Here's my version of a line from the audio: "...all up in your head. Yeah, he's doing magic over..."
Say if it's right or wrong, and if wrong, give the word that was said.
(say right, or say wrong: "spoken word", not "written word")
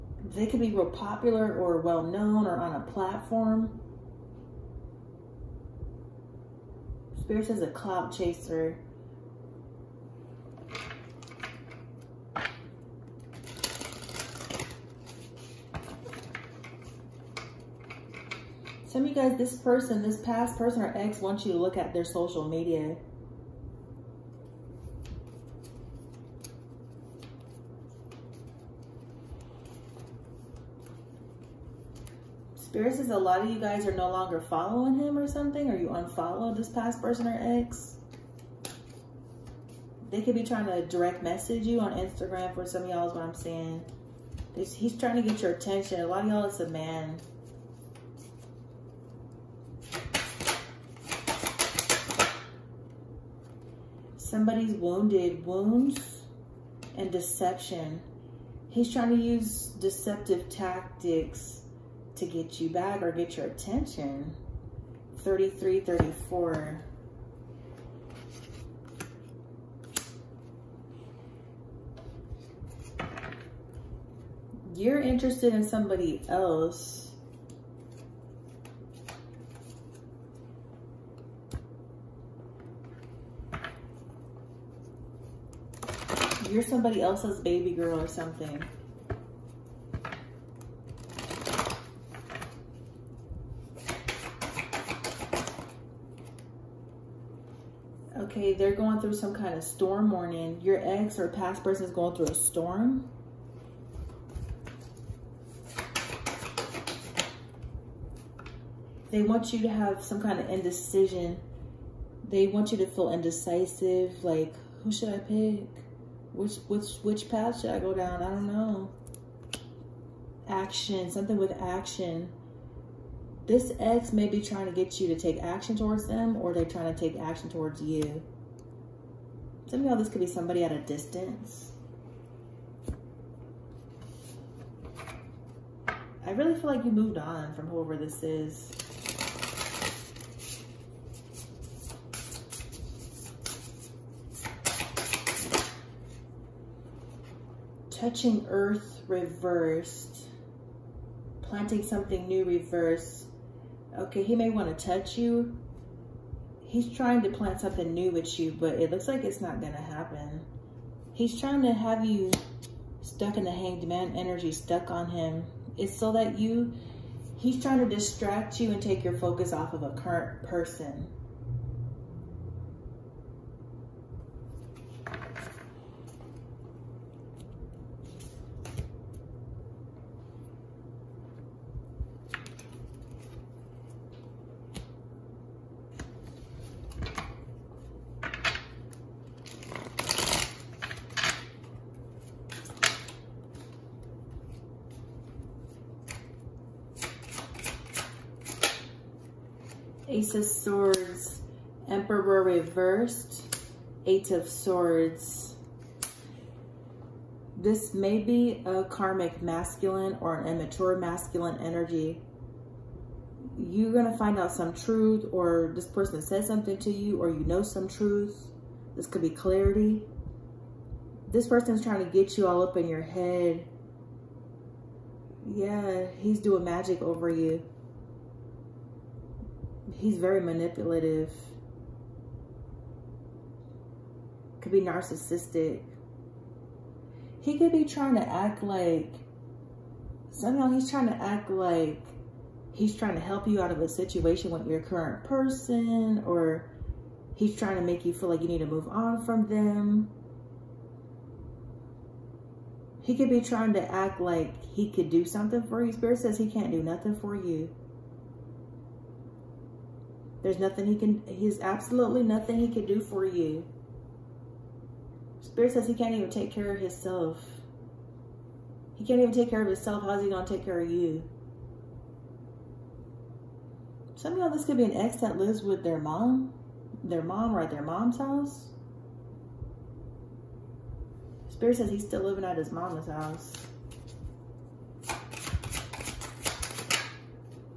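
right.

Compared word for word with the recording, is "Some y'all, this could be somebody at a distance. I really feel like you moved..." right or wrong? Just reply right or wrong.
right.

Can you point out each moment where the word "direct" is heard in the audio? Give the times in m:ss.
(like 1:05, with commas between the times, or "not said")
0:40.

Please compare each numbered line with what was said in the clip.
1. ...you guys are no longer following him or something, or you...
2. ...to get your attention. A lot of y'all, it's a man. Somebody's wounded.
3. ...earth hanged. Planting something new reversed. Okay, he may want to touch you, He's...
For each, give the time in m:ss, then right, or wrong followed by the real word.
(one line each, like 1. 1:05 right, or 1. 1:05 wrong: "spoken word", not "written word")
1. 0:33 right
2. 0:45 right
3. 2:28 wrong: "reversed", not "hanged".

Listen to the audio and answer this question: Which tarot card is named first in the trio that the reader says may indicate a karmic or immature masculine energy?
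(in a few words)
Ace of Swords.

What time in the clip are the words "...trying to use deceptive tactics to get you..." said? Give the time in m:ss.
0:58.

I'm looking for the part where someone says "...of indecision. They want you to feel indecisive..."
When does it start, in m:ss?
1:50.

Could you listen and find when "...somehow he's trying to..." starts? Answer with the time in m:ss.
4:00.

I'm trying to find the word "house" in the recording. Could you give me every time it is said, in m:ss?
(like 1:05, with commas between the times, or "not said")
4:38, 4:43.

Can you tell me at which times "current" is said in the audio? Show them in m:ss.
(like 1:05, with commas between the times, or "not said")
2:49, 4:04.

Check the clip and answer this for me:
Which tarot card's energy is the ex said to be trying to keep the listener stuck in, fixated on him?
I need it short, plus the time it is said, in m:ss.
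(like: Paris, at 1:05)
The Hanged Man, at 2:43.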